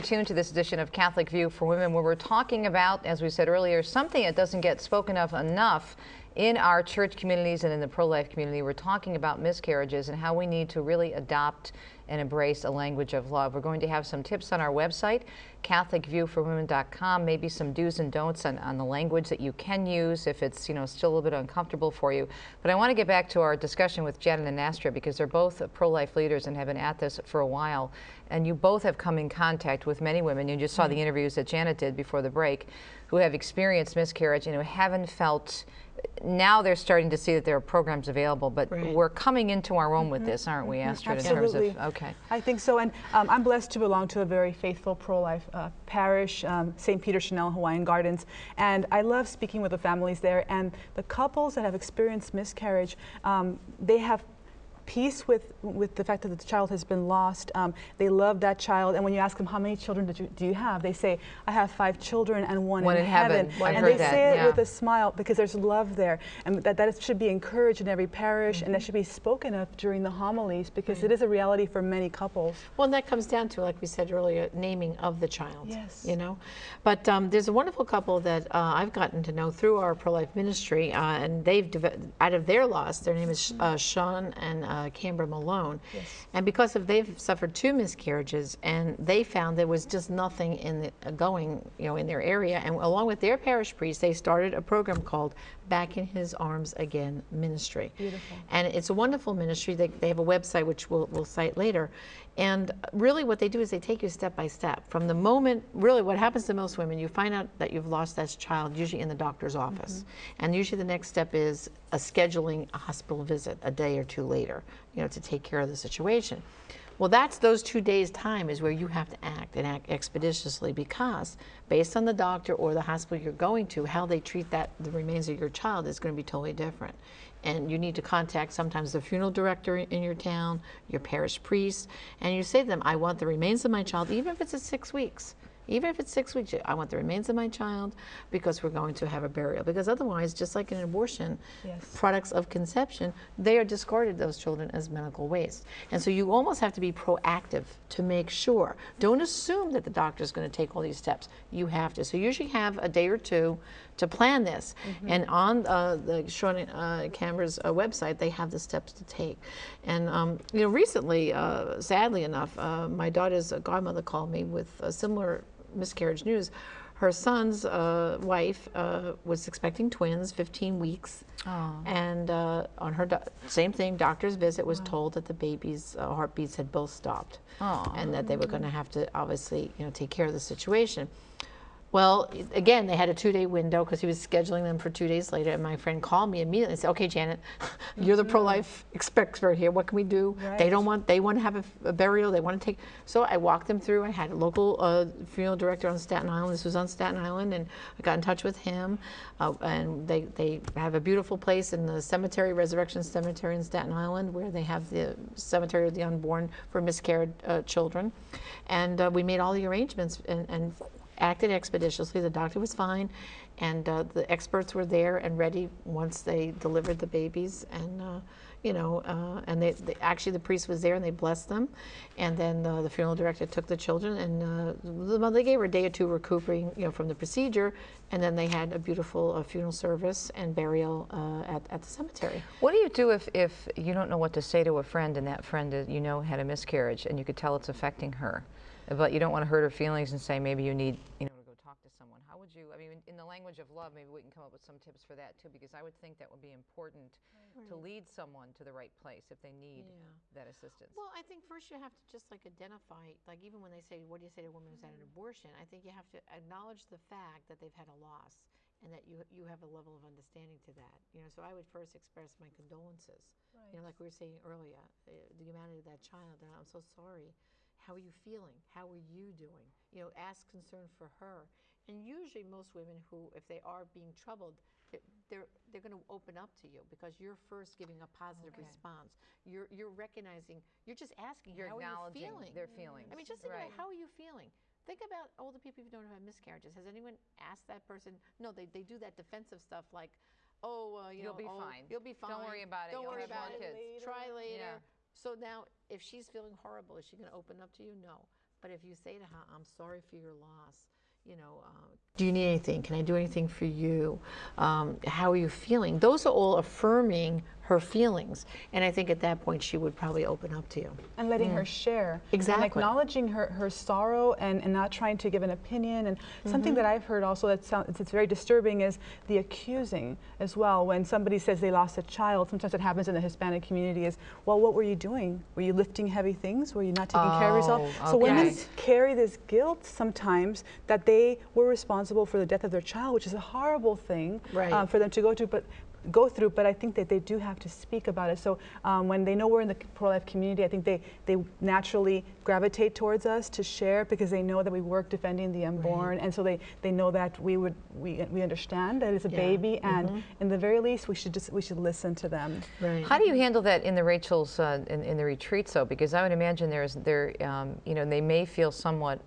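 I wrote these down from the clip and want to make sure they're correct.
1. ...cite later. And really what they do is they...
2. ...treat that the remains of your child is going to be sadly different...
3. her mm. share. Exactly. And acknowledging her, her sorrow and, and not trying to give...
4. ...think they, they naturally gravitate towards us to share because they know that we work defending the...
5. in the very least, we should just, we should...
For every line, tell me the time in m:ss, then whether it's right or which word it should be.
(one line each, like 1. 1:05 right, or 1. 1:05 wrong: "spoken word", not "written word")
1. 1:41 right
2. 2:04 wrong: "totally", not "sadly"
3. 5:11 right
4. 5:40 right
5. 5:50 right.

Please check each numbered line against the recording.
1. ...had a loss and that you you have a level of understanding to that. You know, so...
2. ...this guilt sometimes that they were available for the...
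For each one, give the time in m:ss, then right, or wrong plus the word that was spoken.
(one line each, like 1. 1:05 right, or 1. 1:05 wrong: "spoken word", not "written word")
1. 4:17 right
2. 5:29 wrong: "responsible", not "available".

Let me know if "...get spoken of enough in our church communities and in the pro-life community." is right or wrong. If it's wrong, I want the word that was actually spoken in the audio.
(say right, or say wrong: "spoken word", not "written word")
right.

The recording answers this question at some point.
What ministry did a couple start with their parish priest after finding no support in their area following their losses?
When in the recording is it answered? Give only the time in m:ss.
1:35.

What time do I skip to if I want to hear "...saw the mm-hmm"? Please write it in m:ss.
0:30.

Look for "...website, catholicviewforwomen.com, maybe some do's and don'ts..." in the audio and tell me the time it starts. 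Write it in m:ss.
0:14.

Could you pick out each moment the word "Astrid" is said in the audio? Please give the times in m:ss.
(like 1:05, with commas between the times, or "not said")
0:24, 0:40.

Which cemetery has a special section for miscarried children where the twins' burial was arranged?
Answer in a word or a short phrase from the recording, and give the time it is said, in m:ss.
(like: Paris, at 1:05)
Resurrection Cemetery, at 3:22.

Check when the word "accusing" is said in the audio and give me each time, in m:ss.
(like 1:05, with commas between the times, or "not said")
5:19.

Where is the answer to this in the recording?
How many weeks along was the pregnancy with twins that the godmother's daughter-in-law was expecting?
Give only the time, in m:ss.
2:50.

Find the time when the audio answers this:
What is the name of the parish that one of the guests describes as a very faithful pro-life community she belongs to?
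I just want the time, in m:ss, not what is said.
0:46.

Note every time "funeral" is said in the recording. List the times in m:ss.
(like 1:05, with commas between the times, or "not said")
2:08, 3:15, 3:42, 3:49.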